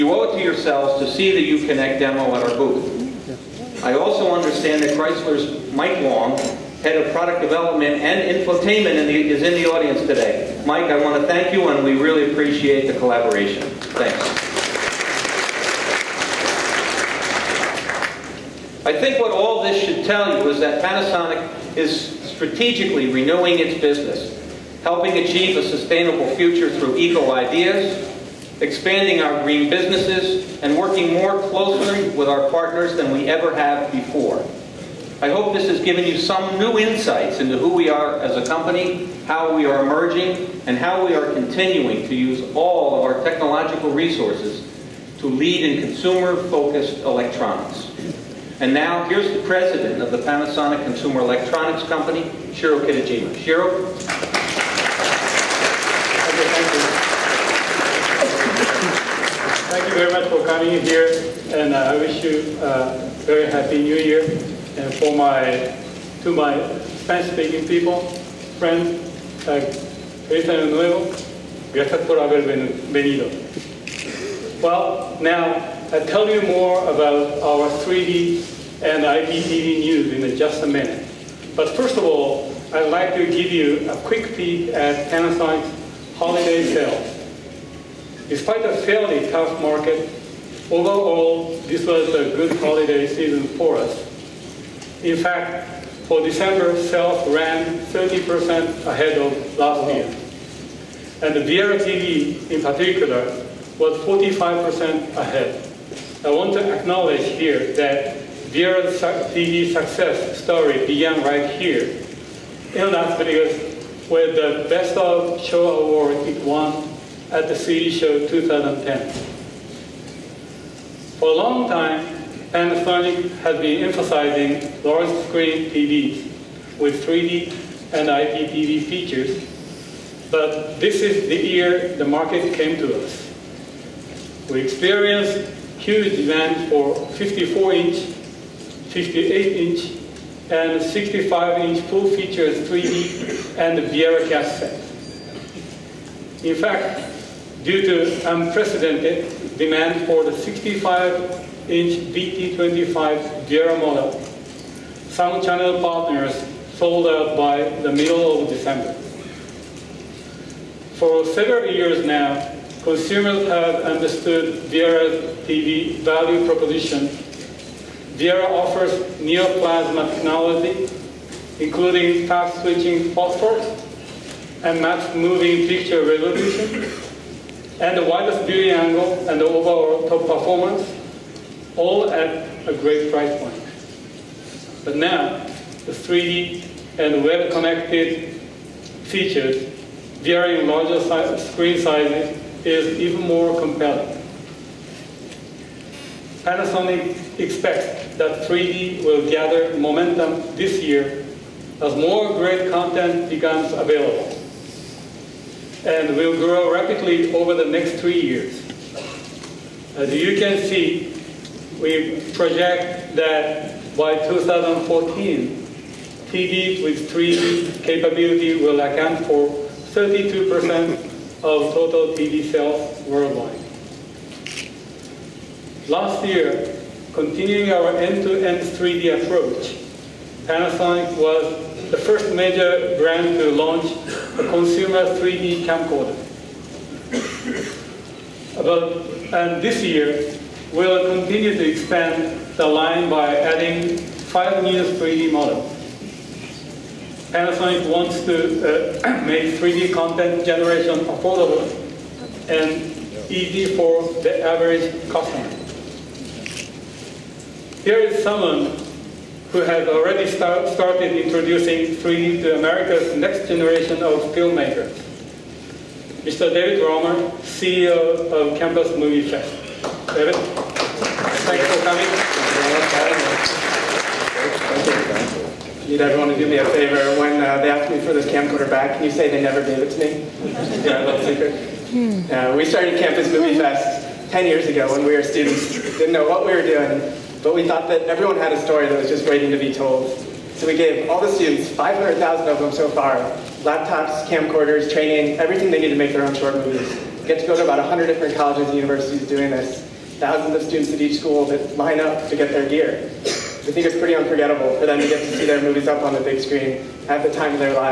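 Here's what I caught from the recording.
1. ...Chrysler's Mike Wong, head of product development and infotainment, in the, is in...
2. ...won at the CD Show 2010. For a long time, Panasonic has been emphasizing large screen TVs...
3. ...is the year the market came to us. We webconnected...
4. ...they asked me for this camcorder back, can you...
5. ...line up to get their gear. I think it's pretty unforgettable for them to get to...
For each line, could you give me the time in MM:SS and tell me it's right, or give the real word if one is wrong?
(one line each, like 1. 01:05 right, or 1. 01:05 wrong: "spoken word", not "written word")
1. 00:04 right
2. 01:56 right
3. 02:11 wrong: "experienced", not "webconnected"
4. 04:37 right
5. 05:01 right.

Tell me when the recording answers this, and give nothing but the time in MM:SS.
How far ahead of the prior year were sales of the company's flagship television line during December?
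01:44.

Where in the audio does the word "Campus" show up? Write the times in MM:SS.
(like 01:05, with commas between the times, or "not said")
04:28, 04:42.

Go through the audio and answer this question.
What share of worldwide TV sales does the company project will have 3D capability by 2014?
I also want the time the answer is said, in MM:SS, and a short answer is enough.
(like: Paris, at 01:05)
32%, at 03:39.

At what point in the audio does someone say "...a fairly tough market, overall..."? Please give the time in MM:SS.
01:28.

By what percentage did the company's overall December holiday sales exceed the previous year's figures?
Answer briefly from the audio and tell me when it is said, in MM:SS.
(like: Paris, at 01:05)
30%, at 01:37.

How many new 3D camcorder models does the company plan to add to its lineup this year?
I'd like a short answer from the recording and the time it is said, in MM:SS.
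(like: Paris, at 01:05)
5, at 04:04.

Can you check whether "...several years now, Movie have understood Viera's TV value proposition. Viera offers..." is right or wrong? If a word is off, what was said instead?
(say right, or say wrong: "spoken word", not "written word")
wrong: "Consumers", not "Movie".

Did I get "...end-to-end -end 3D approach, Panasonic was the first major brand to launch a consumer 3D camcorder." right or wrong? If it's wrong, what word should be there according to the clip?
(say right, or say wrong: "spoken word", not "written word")
right.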